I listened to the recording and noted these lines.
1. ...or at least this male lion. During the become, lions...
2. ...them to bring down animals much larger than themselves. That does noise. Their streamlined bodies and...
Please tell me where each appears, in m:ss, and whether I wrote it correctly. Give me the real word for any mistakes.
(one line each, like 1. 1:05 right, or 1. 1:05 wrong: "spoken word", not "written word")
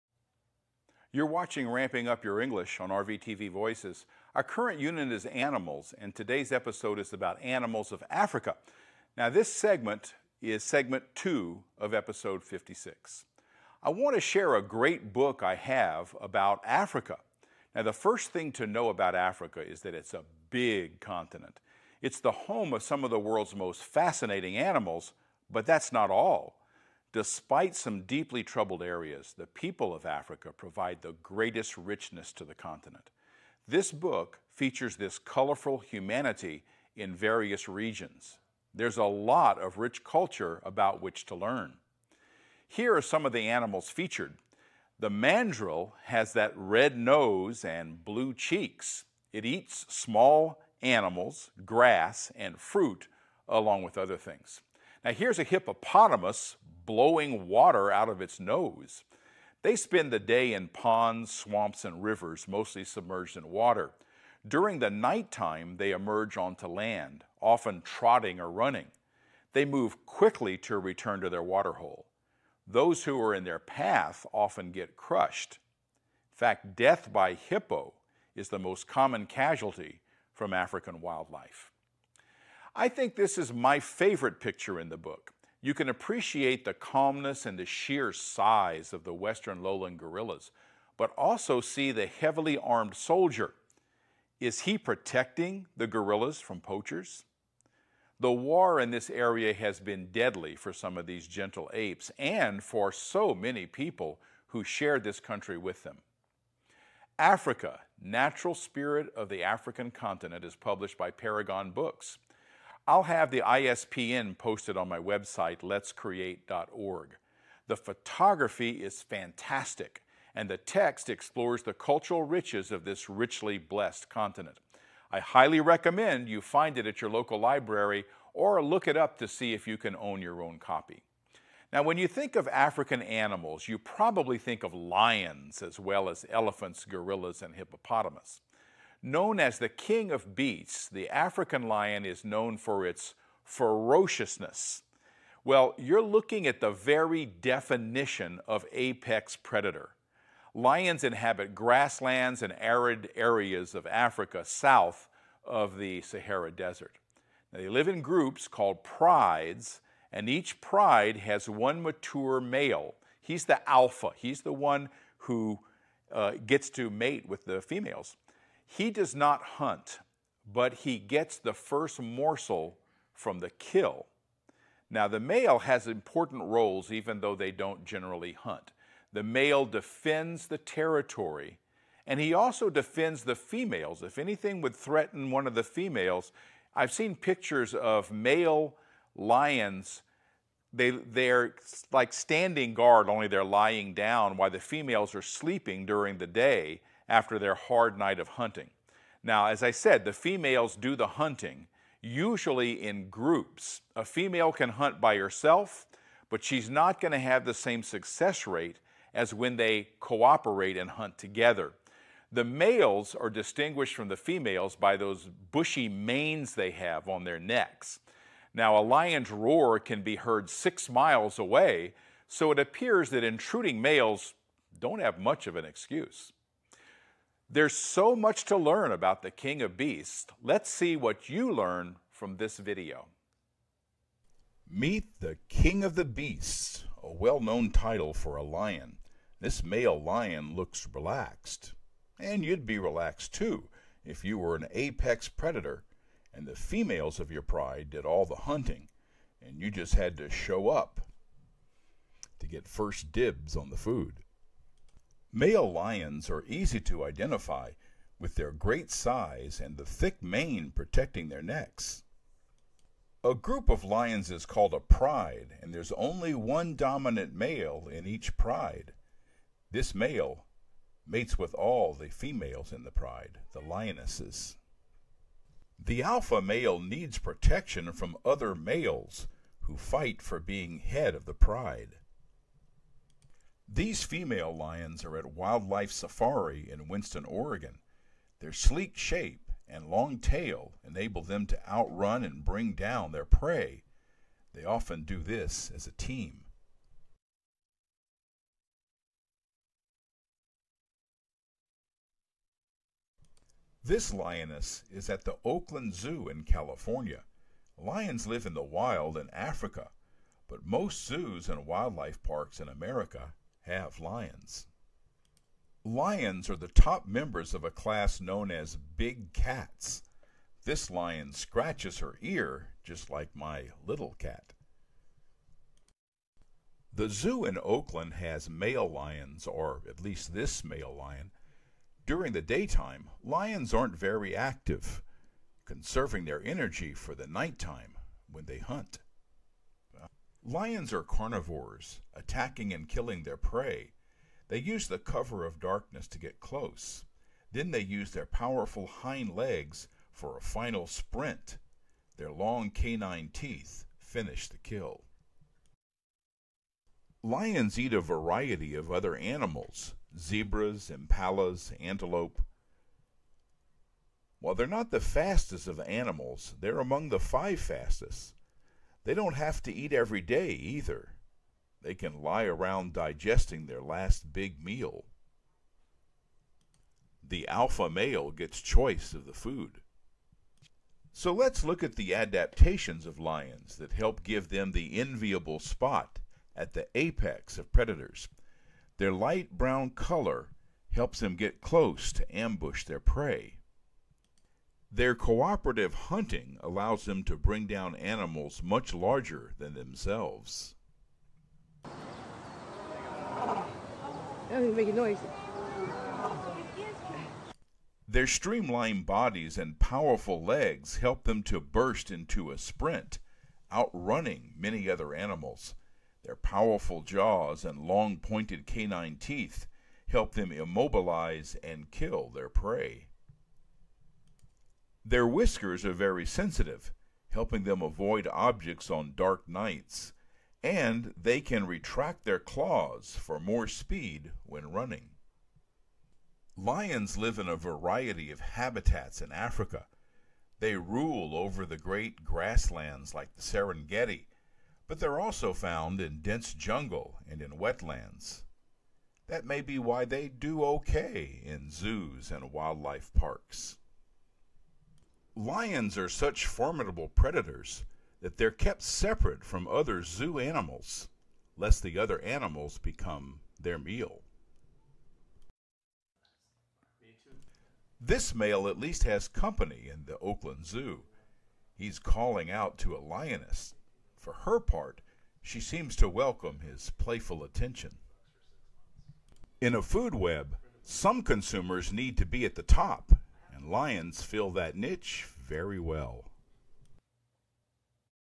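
1. 5:29 wrong: "daytime", not "become"
2. 6:37 right.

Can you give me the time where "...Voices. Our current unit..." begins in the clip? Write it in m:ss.
0:03.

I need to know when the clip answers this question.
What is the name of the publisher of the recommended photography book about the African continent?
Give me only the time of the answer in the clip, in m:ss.
1:51.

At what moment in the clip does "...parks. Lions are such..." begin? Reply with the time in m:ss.
7:33.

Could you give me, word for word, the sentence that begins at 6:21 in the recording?
So let's look at the adaptations of lions that help give them the enviable spot at the apex of predators.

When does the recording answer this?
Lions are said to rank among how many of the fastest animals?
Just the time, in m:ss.
6:07.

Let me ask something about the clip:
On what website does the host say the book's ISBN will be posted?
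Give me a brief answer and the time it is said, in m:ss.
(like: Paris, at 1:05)
LetzCreate.org, at 1:55.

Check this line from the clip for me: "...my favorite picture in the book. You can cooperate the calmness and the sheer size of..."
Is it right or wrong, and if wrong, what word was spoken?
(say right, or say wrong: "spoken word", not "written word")
wrong: "appreciate", not "cooperate".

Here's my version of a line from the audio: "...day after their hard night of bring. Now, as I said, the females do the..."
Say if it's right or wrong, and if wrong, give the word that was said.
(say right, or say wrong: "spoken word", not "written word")
wrong: "hunting", not "bring".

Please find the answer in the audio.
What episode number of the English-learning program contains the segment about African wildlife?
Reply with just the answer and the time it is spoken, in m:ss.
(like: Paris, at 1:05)
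56, at 0:11.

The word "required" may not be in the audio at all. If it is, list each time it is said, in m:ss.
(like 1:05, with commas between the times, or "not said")
not said.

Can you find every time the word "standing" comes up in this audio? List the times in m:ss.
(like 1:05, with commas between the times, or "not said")
3:12.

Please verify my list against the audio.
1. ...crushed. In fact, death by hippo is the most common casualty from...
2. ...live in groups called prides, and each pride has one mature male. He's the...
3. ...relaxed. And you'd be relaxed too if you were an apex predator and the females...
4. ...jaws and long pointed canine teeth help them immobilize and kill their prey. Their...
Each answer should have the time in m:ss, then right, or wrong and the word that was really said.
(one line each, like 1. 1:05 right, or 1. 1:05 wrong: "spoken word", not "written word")
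1. 1:14 right
2. 2:37 right
3. 4:00 right
4. 6:57 right.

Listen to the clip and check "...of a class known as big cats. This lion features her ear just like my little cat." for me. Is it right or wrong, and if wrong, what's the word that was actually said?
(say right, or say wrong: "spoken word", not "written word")
wrong: "scratches", not "features".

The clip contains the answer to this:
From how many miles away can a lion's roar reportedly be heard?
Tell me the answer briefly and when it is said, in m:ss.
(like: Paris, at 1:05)
6, at 3:40.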